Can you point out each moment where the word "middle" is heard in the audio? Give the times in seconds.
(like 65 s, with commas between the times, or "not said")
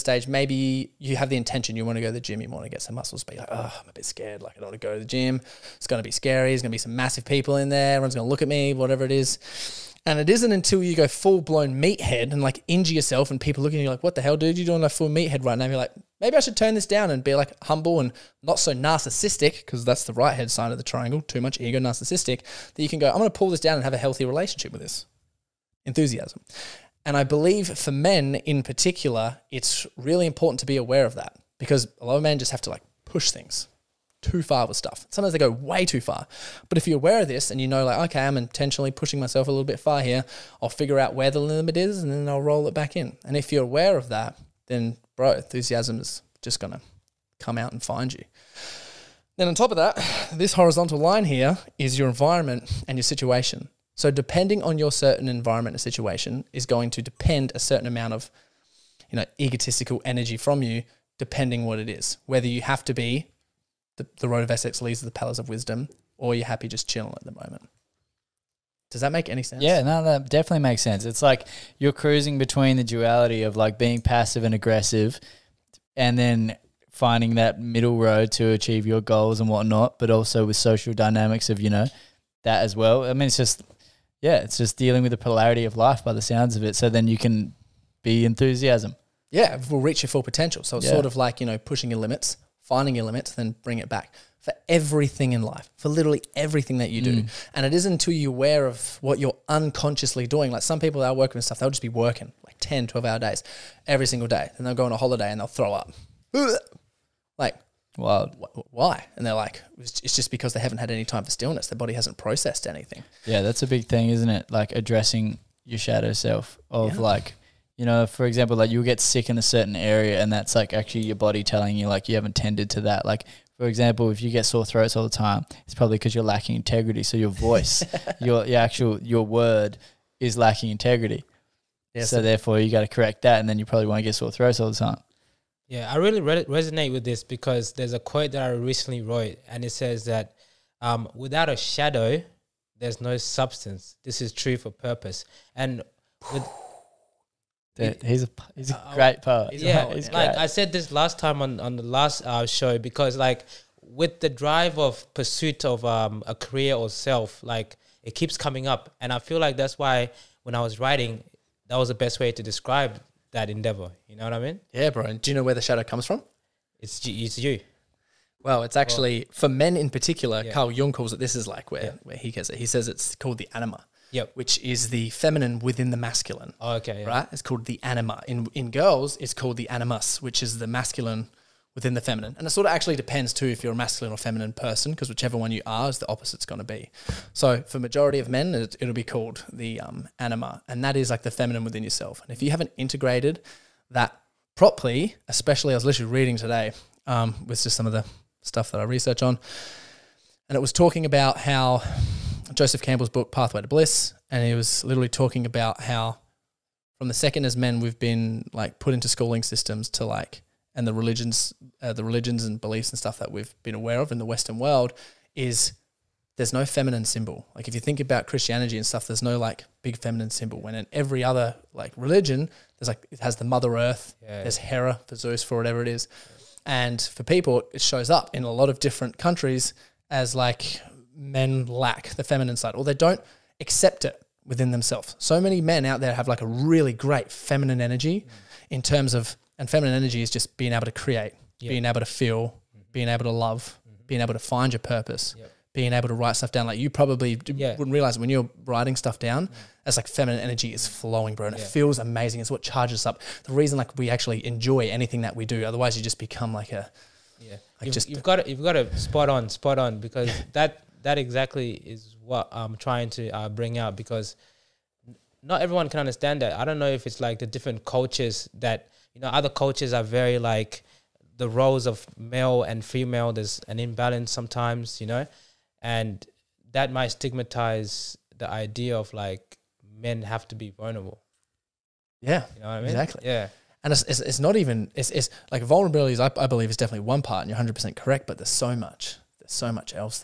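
77 s.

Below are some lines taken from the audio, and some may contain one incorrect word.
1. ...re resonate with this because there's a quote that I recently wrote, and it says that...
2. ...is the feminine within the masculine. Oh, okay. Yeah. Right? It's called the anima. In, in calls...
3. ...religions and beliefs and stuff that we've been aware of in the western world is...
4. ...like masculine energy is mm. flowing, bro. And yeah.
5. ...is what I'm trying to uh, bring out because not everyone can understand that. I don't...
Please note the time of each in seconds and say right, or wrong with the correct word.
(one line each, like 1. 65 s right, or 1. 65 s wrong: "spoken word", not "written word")
1. 136 s right
2. 174 s wrong: "girls", not "calls"
3. 212 s right
4. 249 s wrong: "feminine", not "masculine"
5. 261 s right.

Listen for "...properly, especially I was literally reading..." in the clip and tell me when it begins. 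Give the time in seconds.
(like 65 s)
194 s.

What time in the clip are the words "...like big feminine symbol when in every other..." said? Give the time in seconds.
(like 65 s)
219 s.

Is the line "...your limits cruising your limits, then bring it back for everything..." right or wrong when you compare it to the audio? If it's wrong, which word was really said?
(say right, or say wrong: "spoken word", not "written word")
wrong: "finding", not "cruising".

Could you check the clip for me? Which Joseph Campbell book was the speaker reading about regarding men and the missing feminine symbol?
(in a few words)
Pathway to Bliss.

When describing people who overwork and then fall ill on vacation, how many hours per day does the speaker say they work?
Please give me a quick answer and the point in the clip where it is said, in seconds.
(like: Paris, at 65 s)
10 to 12, at 102 s.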